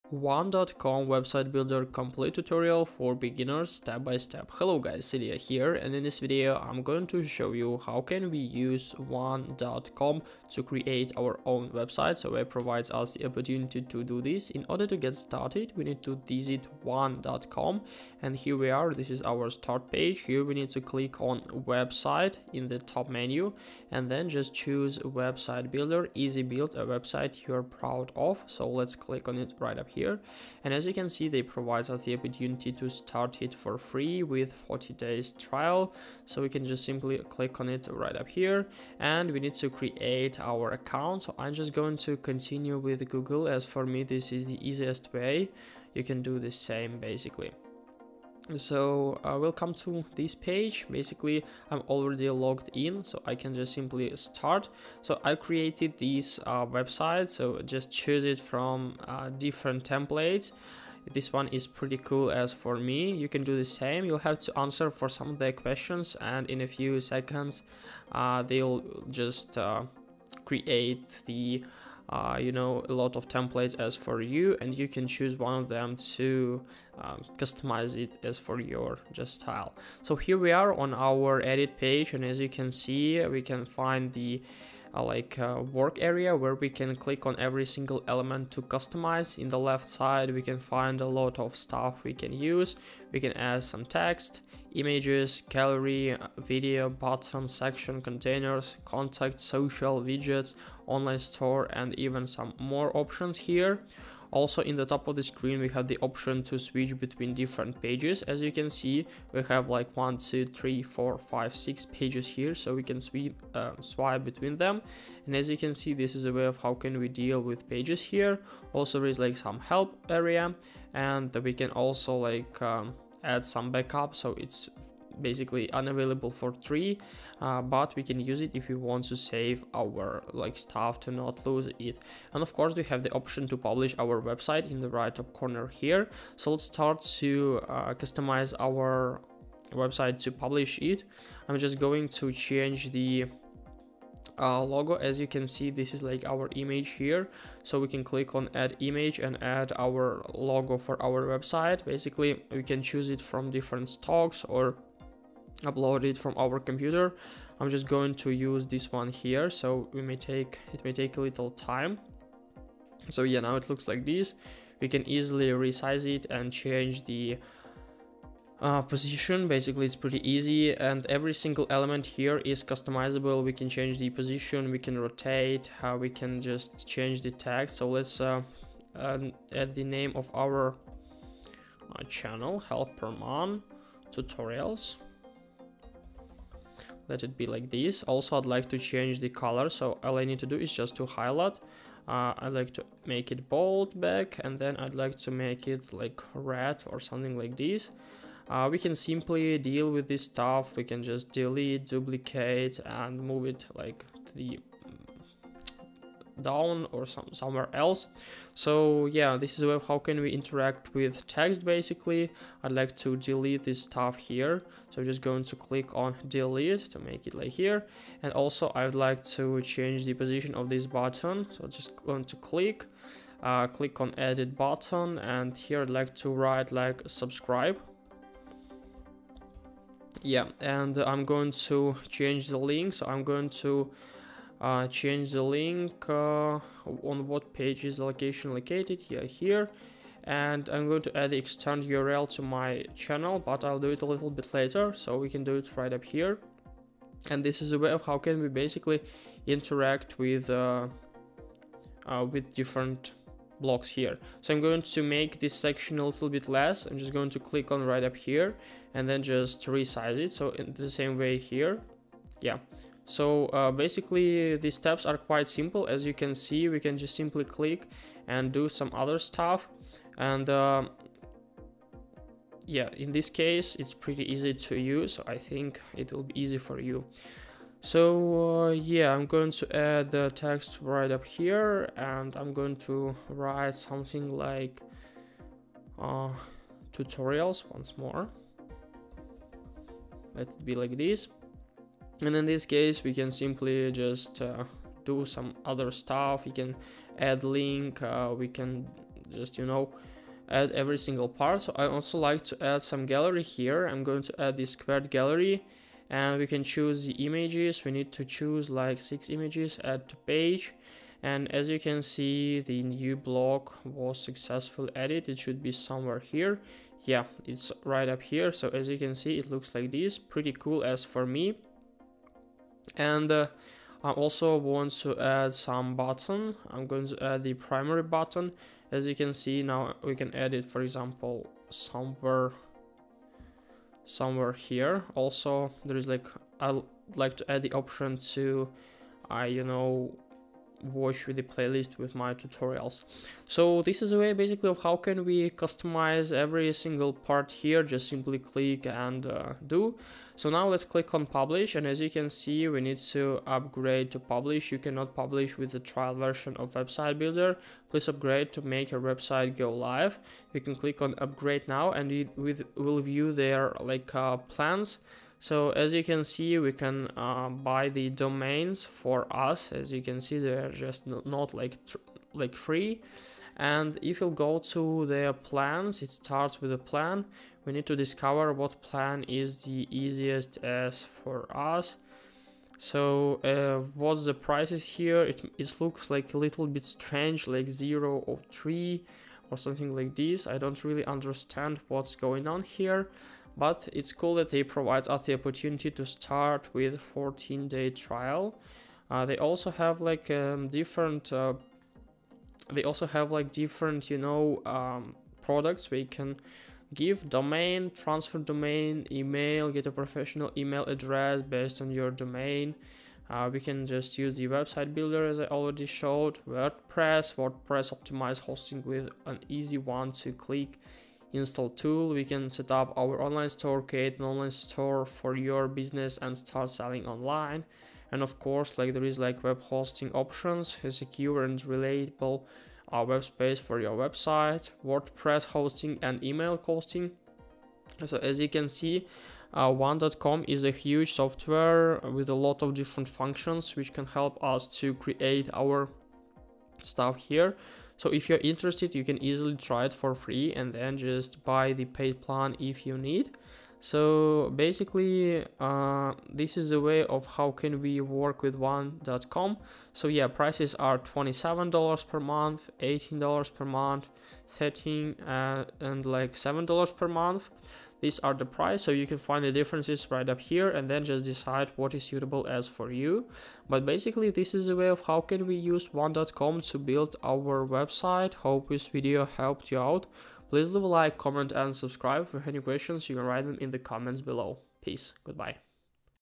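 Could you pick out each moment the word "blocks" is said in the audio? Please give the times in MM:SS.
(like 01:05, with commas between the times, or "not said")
04:13, 05:13.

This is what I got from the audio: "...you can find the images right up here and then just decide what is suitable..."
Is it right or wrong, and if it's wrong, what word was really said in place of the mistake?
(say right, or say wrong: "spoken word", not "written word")
wrong: "differences", not "images".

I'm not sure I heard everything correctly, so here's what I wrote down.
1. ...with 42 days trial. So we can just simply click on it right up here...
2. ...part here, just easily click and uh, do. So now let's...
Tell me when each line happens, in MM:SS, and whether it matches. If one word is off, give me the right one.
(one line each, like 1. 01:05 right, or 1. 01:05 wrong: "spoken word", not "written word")
1. 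00:34 wrong: "40", not "42"
2. 05:47 wrong: "simply", not "easily".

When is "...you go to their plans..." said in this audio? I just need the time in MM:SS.
06:14.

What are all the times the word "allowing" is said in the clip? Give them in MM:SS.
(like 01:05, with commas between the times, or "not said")
not said.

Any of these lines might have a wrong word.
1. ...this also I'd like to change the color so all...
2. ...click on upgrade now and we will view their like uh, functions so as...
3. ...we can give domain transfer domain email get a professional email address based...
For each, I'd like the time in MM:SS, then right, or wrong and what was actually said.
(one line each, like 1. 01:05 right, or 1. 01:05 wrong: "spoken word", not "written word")
1. 03:07 right
2. 06:00 wrong: "plans", not "functions"
3. 06:45 right.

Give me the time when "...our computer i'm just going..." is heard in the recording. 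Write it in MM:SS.
02:36.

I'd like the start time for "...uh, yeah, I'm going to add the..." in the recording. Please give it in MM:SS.
04:38.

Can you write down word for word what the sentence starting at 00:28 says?
So let's click on it right up here here.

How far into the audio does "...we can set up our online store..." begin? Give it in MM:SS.
07:02.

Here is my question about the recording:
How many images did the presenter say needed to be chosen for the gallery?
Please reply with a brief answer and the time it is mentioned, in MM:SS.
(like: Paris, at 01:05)
6, at 05:08.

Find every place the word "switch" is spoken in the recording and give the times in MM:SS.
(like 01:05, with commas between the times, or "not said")
01:46.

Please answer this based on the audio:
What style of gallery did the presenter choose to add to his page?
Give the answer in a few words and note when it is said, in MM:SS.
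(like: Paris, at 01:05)
Squared gallery, at 05:04.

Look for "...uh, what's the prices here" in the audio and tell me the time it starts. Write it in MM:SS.
06:23.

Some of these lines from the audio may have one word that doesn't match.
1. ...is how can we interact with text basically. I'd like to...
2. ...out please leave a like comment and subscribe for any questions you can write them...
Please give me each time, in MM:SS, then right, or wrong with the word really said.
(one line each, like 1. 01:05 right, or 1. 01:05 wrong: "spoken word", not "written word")
1. 03:29 right
2. 07:59 right.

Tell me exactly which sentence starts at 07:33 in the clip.
So basically, uh, this is a way of how can we work with one.com.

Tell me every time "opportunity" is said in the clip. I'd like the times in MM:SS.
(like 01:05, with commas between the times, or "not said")
00:13, 00:32, 06:35.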